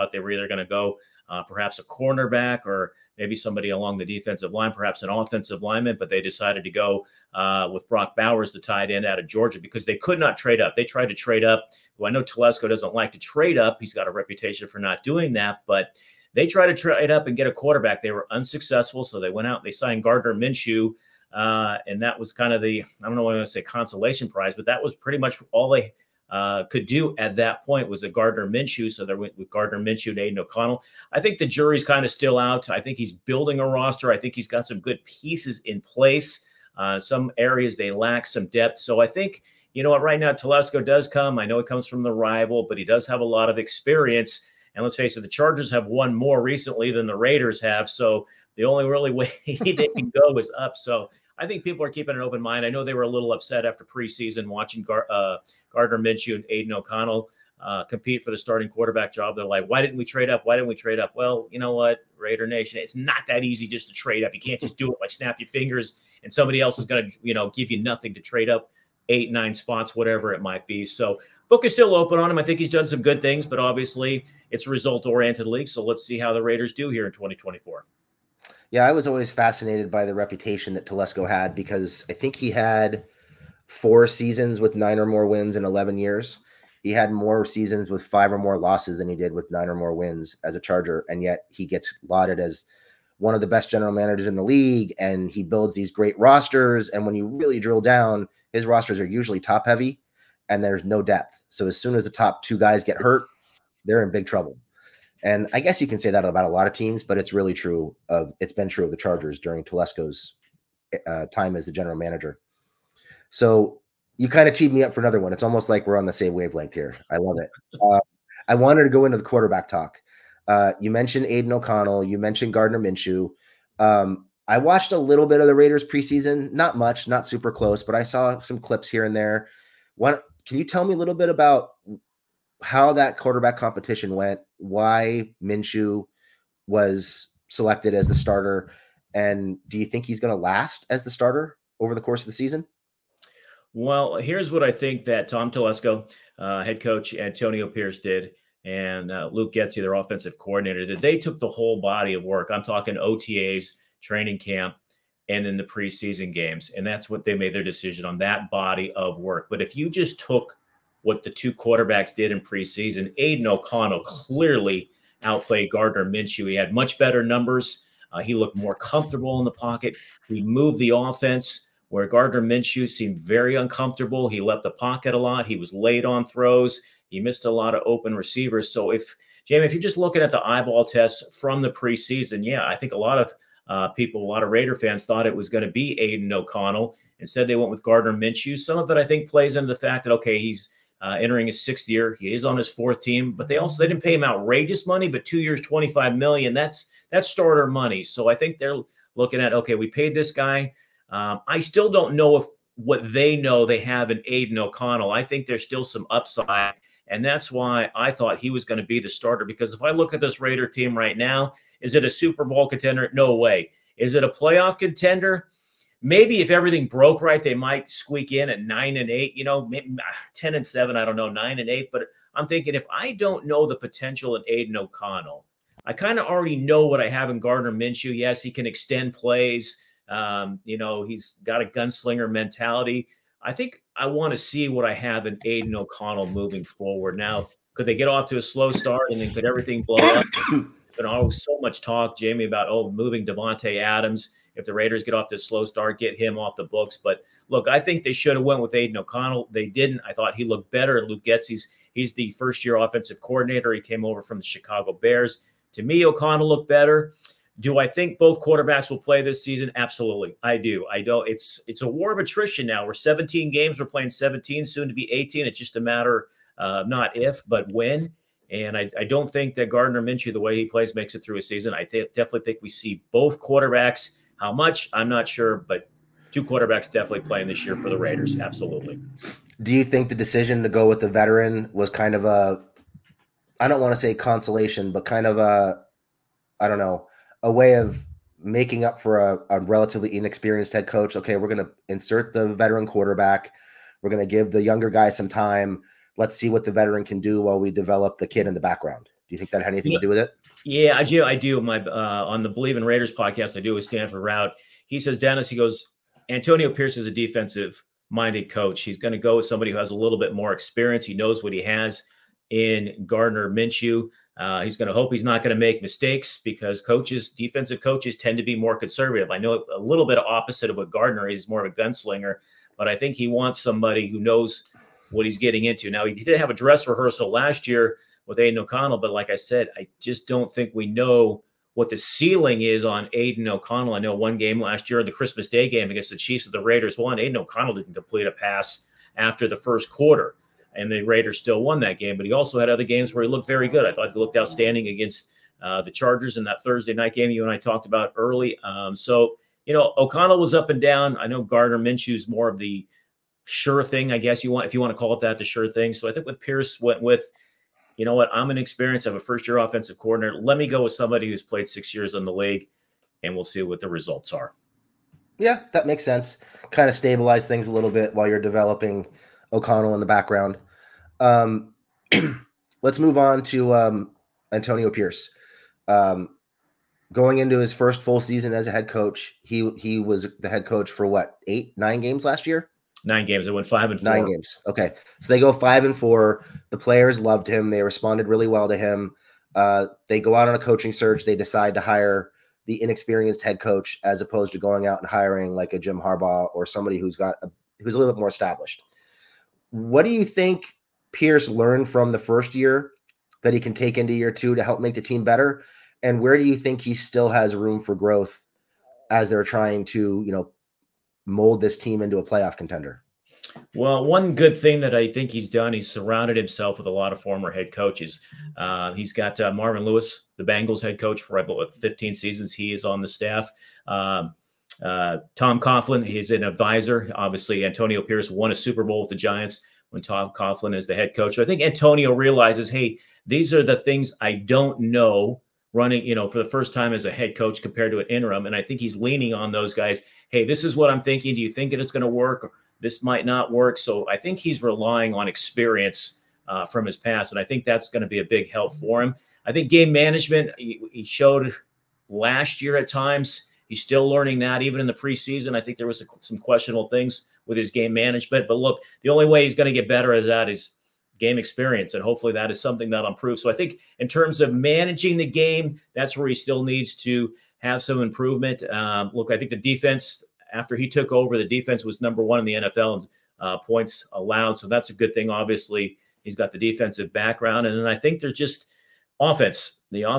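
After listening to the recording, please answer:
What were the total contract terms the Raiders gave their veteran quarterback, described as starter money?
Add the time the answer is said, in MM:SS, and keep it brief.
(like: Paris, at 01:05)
2 years, $25 million, at 03:15.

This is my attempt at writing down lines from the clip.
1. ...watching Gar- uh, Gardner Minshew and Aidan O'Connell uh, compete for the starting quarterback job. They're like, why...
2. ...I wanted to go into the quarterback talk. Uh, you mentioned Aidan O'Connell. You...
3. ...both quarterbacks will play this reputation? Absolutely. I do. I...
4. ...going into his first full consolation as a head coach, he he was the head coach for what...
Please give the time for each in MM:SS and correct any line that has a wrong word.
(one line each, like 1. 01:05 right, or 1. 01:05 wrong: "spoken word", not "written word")
1. 00:54 right
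2. 01:58 right
3. 04:18 wrong: "season", not "reputation"
4. 06:17 wrong: "season", not "consolation".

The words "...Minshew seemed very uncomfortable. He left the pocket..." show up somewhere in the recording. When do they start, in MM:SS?
02:52.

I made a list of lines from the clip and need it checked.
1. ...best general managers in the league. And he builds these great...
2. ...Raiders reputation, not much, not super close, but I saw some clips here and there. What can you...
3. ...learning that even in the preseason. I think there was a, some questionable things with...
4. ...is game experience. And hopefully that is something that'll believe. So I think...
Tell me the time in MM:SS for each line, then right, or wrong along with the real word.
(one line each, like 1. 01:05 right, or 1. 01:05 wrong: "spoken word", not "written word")
1. 01:33 right
2. 02:05 wrong: "preseason", not "reputation"
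3. 07:34 right
4. 07:40 wrong: "improve", not "believe".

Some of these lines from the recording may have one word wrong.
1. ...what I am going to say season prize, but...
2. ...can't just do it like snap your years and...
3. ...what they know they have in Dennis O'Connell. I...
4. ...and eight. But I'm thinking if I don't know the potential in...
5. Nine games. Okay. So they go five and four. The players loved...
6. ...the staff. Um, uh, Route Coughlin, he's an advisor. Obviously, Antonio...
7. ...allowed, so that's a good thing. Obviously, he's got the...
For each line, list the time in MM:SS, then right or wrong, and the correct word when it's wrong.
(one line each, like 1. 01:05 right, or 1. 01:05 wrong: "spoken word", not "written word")
1. 00:23 wrong: "consolation", not "season"
2. 01:04 wrong: "fingers", not "years"
3. 03:22 wrong: "Aidan", not "Dennis"
4. 03:41 right
5. 06:24 right
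6. 07:03 wrong: "Tom", not "Route"
7. 07:54 right.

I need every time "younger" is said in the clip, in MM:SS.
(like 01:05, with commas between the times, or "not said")
04:54.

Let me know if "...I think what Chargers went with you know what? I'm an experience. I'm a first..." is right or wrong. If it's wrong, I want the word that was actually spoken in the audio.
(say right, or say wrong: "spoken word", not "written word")
wrong: "Pierce", not "Chargers".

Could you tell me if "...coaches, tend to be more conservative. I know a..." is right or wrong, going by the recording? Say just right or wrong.
right.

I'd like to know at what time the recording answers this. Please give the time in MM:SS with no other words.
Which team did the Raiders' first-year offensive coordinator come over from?
04:14.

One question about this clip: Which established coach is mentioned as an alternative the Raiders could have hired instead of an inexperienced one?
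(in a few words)
Jim Harbaugh.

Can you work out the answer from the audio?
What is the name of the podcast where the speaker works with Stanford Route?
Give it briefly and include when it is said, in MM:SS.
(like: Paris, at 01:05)
Bleav in Raiders, at 05:02.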